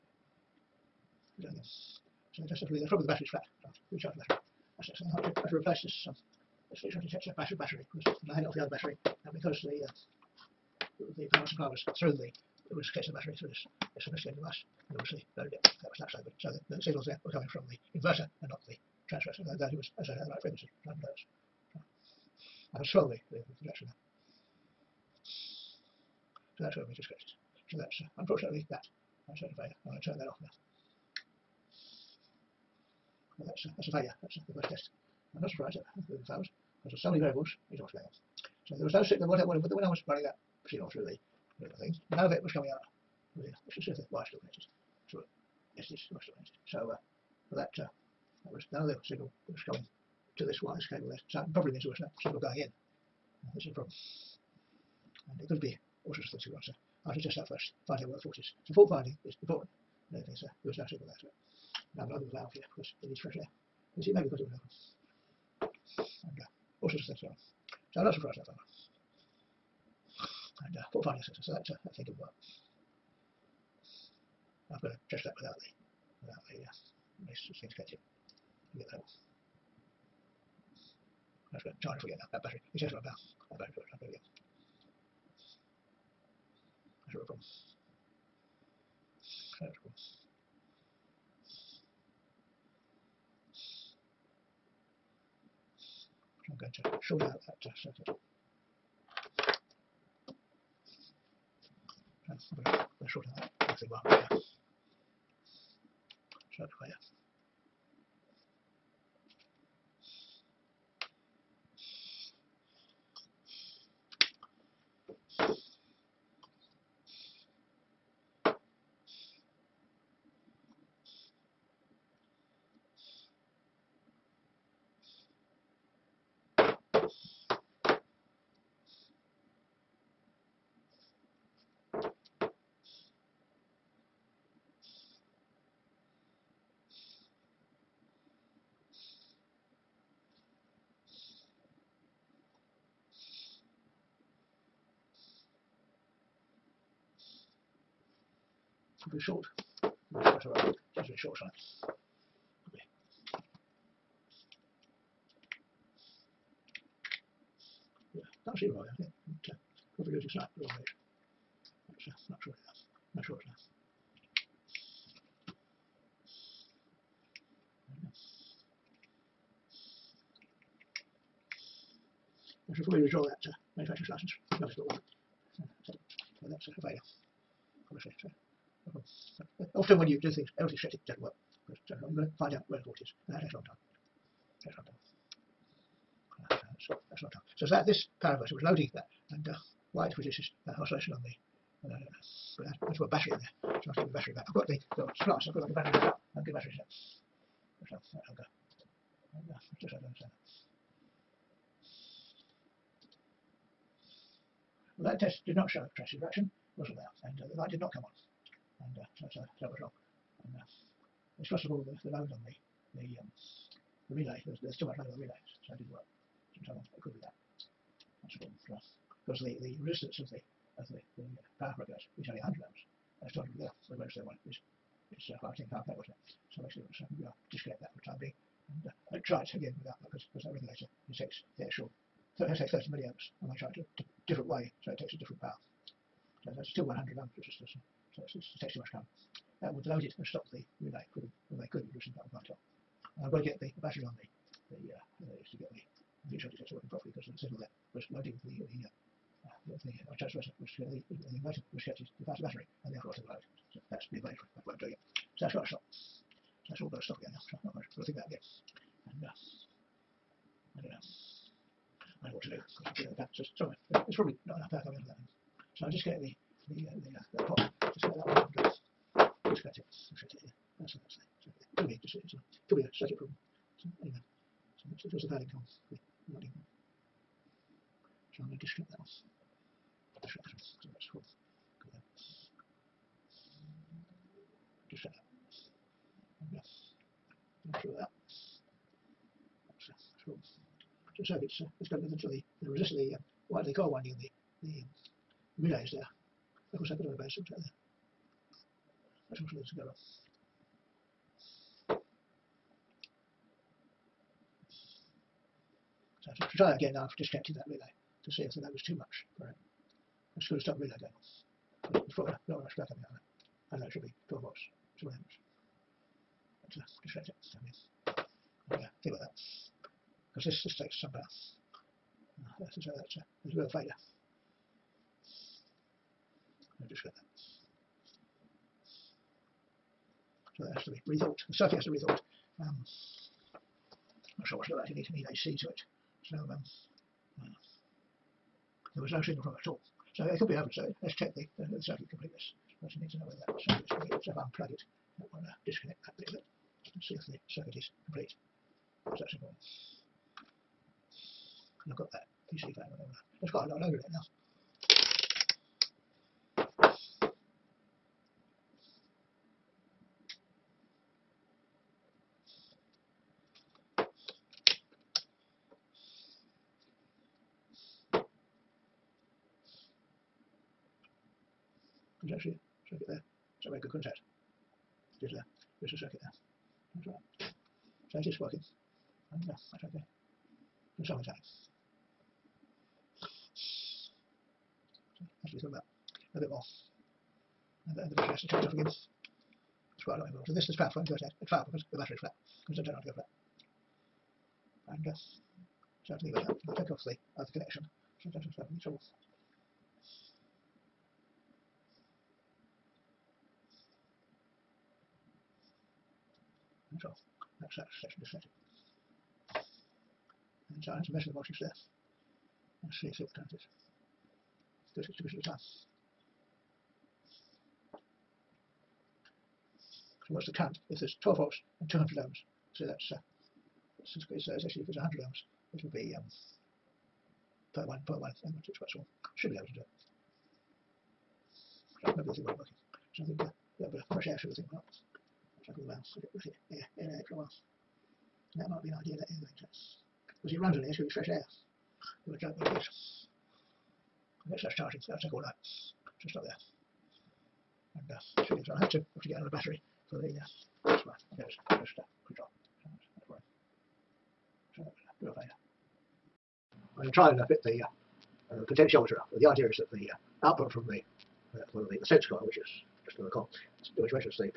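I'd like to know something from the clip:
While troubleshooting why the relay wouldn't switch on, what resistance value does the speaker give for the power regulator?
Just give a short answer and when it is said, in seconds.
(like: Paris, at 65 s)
100 ohms, at 222 s.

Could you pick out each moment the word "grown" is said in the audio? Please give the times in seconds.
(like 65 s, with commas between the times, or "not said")
not said.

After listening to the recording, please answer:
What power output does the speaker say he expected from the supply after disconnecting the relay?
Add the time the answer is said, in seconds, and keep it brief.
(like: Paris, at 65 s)
12 watts, at 314 s.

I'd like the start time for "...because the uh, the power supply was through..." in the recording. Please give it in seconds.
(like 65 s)
9 s.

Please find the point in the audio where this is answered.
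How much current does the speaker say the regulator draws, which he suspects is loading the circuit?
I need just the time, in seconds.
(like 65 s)
232 s.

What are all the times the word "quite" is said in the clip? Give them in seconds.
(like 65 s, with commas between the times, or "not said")
353 s, 390 s, 428 s.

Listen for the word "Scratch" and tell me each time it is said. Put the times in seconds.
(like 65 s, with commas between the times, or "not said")
269 s.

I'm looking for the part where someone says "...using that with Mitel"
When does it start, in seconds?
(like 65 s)
241 s.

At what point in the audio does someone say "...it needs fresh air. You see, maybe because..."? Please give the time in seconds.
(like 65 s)
63 s.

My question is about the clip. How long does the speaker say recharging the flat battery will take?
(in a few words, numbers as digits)
All night.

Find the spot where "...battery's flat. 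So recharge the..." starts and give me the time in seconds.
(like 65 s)
3 s.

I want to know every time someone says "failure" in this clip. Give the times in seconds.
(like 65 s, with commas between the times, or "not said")
29 s, 33 s, 176 s, 323 s, 455 s.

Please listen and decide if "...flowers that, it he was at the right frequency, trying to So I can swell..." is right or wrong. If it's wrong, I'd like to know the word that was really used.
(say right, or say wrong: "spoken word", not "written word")
wrong: "transfers", not "flowers".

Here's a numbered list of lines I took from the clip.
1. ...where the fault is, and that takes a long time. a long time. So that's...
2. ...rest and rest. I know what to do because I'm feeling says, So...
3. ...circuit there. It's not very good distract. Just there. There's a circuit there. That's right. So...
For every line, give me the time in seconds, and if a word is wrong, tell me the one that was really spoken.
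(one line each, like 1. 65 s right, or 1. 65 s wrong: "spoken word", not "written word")
1. 182 s right
2. 259 s right
3. 372 s wrong: "contact", not "distract".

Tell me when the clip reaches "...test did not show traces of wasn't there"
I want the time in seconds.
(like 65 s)
205 s.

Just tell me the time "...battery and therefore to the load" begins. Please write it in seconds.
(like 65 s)
252 s.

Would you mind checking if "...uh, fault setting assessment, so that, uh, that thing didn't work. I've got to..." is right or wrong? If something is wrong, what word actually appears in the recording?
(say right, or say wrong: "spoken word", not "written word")
wrong: "finding", not "setting".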